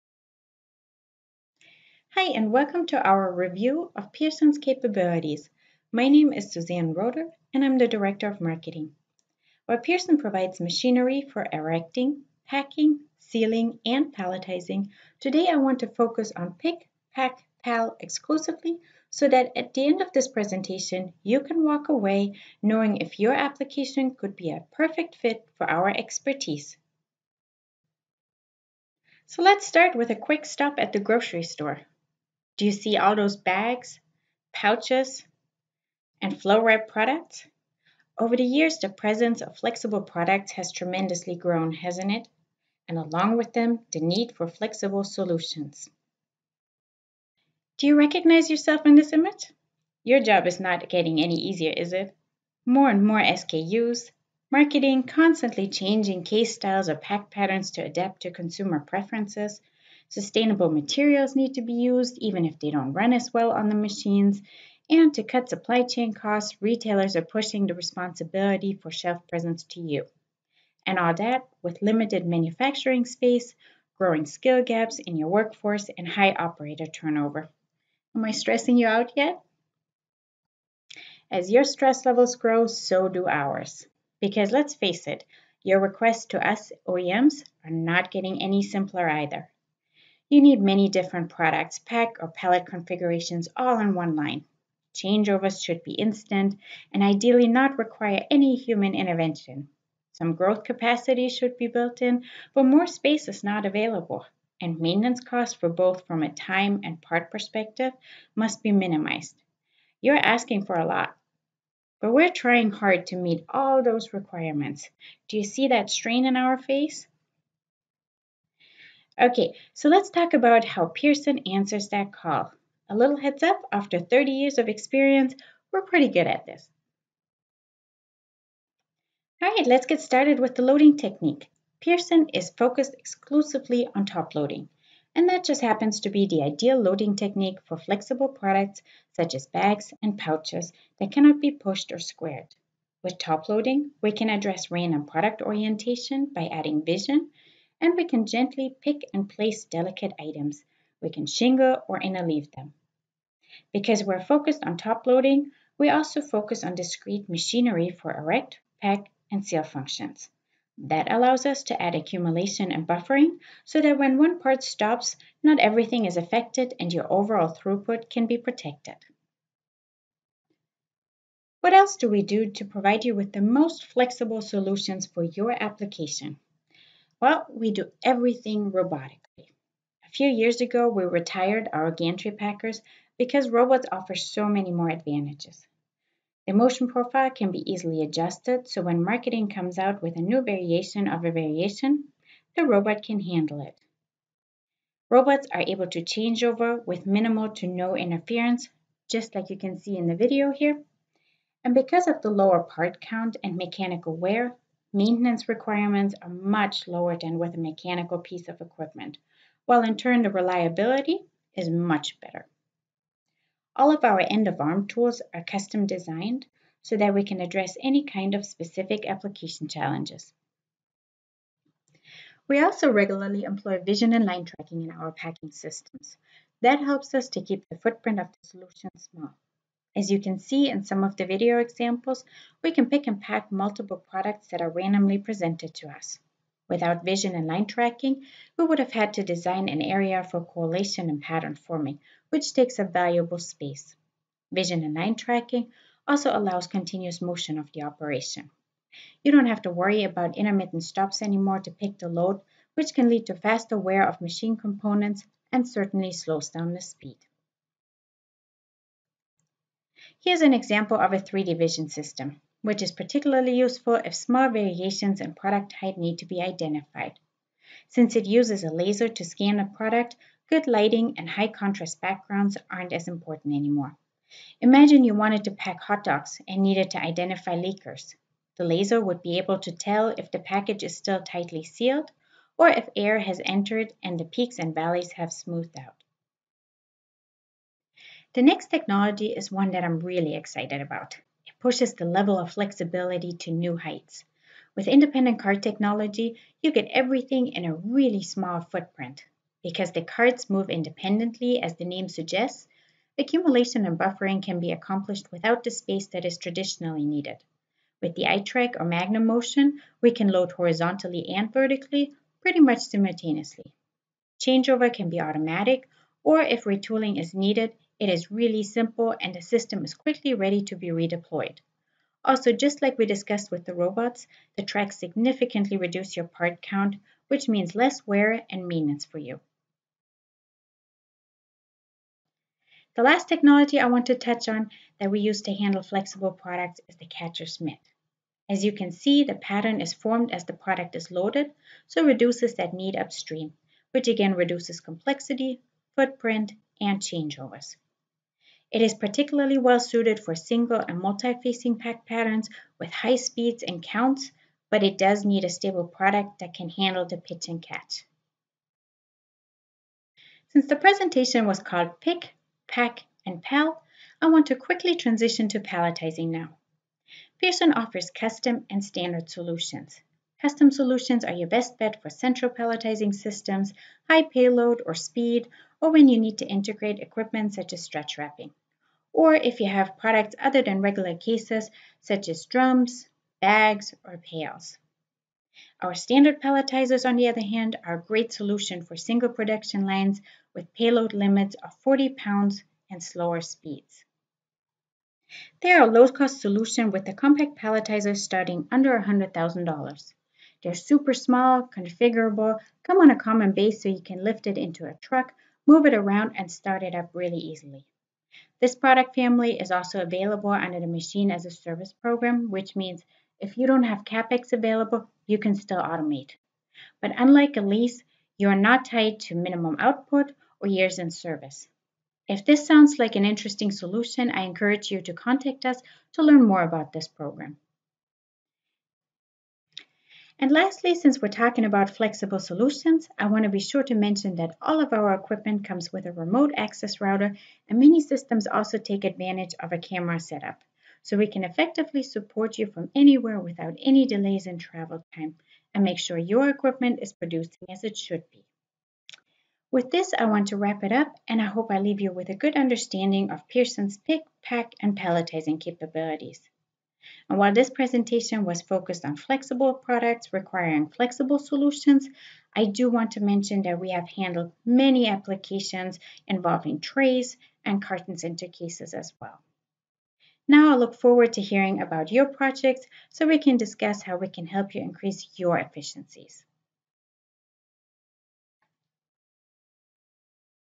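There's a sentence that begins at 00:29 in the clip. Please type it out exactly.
So let's start with a quick stop at the grocery store.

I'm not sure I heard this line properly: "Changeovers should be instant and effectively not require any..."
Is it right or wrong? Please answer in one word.
wrong.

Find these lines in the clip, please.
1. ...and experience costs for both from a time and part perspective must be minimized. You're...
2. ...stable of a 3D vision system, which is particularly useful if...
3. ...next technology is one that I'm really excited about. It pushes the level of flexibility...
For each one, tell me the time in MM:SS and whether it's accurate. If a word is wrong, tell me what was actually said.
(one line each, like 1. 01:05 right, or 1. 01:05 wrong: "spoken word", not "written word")
1. 01:44 wrong: "maintenance", not "experience"
2. 04:20 wrong: "example", not "stable"
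3. 04:48 right.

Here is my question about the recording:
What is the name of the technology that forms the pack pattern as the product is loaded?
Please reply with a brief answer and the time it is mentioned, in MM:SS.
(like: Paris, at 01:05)
catcher mitt, at 05:37.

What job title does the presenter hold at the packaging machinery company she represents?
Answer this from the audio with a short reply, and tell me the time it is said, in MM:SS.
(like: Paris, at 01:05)
Director of Marketing, at 00:07.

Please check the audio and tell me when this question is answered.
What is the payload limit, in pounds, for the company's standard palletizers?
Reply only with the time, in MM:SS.
06:31.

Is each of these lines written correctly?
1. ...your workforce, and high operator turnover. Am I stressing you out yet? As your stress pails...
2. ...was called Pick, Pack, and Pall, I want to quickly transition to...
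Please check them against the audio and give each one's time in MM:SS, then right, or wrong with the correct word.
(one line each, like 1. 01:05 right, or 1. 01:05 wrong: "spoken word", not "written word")
1. 01:15 wrong: "levels", not "pails"
2. 06:01 right.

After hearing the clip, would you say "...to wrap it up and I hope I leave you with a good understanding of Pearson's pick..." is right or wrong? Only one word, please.
right.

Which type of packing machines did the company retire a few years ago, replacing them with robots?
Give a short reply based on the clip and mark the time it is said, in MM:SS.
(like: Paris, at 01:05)
gantry packers, at 03:01.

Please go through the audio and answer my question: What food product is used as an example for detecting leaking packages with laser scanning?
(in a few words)
hot dogs.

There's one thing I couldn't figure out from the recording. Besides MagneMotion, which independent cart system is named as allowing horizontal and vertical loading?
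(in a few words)
iTRAK.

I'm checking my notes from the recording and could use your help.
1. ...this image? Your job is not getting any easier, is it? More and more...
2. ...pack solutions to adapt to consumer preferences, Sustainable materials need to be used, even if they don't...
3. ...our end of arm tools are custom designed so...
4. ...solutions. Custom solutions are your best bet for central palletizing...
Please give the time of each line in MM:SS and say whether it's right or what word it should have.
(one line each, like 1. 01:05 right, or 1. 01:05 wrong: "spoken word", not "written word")
1. 00:48 right
2. 00:56 wrong: "patterns", not "solutions"
3. 03:34 right
4. 06:09 right.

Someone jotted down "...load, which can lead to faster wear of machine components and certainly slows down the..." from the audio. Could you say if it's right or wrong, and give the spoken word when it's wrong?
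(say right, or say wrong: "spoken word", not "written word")
right.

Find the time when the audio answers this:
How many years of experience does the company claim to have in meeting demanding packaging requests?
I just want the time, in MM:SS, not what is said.
02:03.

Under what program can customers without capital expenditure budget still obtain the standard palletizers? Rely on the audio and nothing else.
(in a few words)
Machine as a Service.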